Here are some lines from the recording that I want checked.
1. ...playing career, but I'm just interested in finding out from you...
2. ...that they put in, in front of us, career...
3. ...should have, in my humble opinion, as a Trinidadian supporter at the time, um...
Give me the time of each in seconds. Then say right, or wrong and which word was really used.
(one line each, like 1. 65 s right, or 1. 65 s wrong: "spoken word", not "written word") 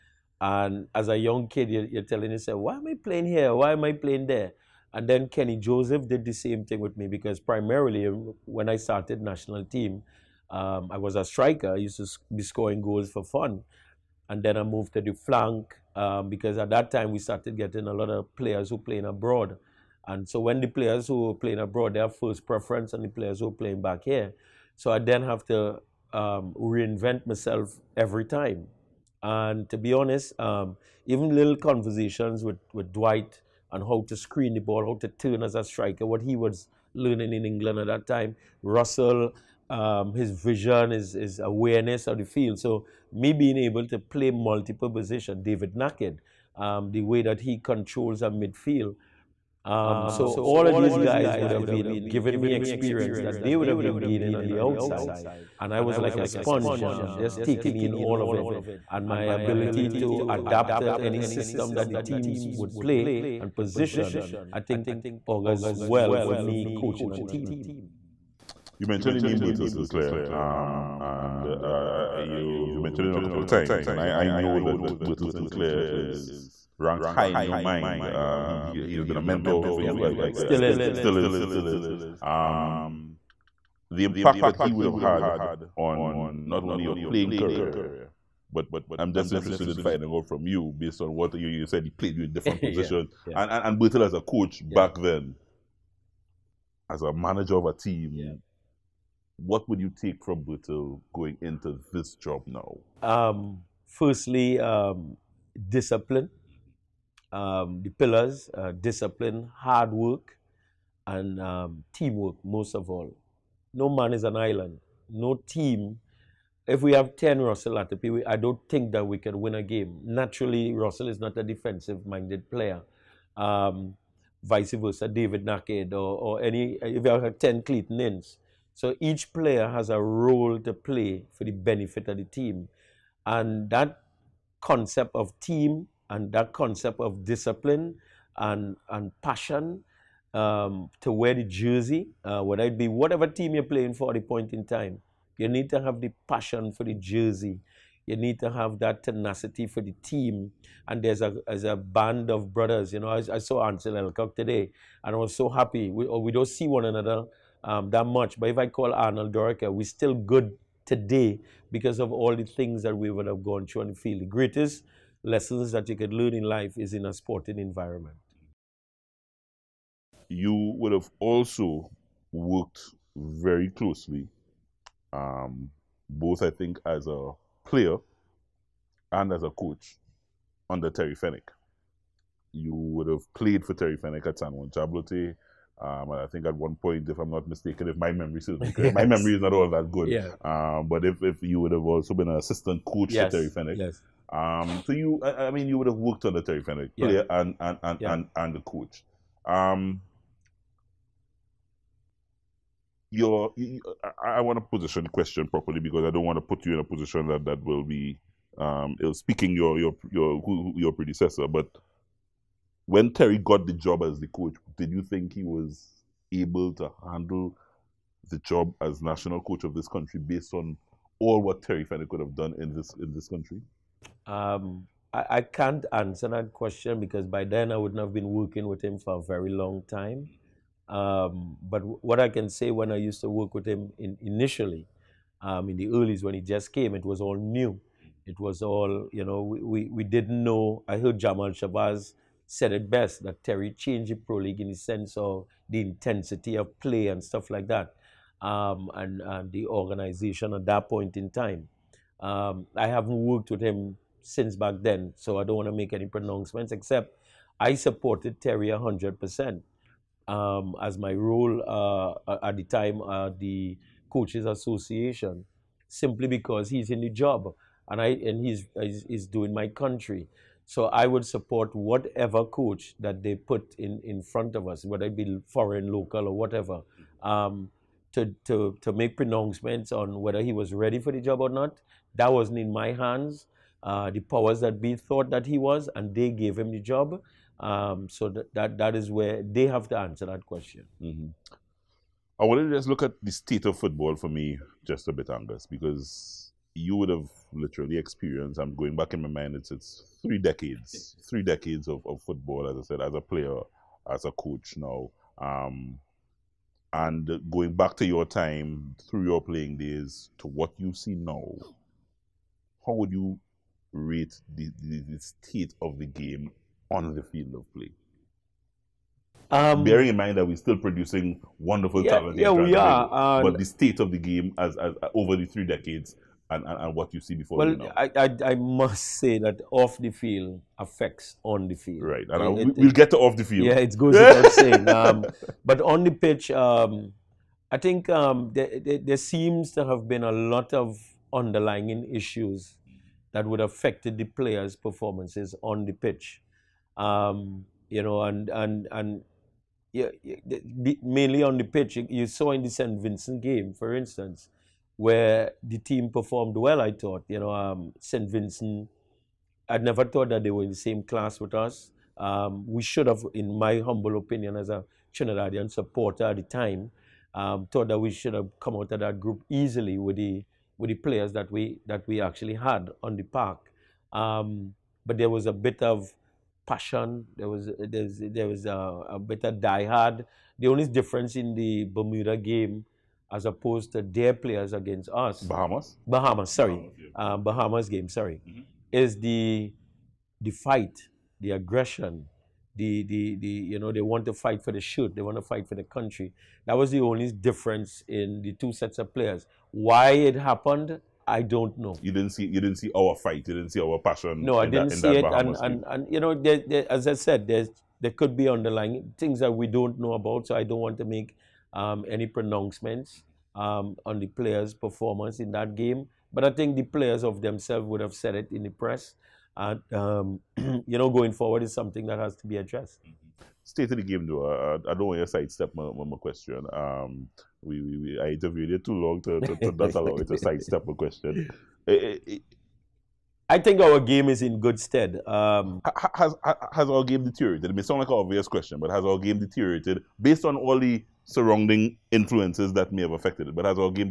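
1. 86 s right
2. 272 s wrong: "whether", not "career"
3. 362 s right.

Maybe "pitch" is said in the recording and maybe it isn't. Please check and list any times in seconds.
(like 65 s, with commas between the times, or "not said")
336 s, 345 s, 351 s.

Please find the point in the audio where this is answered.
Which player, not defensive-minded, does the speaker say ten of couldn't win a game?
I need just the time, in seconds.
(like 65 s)
117 s.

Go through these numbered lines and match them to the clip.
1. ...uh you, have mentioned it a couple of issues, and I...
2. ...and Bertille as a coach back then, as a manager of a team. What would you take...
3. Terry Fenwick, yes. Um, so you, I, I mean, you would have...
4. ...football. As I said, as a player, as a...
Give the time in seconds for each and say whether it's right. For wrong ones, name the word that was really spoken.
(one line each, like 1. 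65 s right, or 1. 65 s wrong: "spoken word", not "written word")
1. 71 s wrong: "times", not "issues"
2. 93 s right
3. 193 s right
4. 302 s right.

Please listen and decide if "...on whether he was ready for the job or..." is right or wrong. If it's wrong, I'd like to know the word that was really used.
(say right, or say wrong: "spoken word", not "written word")
right.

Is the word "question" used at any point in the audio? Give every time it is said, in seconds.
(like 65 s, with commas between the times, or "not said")
205 s, 226 s, 290 s, 426 s, 430 s, 438 s.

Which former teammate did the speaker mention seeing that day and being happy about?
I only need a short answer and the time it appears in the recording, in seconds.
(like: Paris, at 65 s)
Ansil Elcock, at 153 s.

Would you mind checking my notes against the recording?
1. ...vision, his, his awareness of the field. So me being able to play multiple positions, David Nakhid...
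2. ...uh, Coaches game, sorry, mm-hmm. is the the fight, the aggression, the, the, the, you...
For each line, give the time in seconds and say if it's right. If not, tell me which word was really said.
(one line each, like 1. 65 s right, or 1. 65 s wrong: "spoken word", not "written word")
1. 40 s right
2. 387 s wrong: "Bahamas", not "Coaches".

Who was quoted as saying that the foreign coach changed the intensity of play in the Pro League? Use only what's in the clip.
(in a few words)
Jamal Shabazz.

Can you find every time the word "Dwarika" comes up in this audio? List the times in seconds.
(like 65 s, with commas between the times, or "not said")
159 s.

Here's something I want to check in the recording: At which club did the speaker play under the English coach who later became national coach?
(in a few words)
San Juan Jabloteh.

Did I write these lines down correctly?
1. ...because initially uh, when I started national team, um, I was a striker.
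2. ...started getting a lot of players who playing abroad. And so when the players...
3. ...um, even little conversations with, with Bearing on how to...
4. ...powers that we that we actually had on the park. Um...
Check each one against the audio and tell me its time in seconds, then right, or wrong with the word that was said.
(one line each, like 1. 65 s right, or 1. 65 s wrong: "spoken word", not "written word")
1. 7 s wrong: "primarily", not "initially"
2. 17 s right
3. 30 s wrong: "Dwight", not "Bearing"
4. 370 s wrong: "players", not "powers".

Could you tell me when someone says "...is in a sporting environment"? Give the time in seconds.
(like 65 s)
166 s.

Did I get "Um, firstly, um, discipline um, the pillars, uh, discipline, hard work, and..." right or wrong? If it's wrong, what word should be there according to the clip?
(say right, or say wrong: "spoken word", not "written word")
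right.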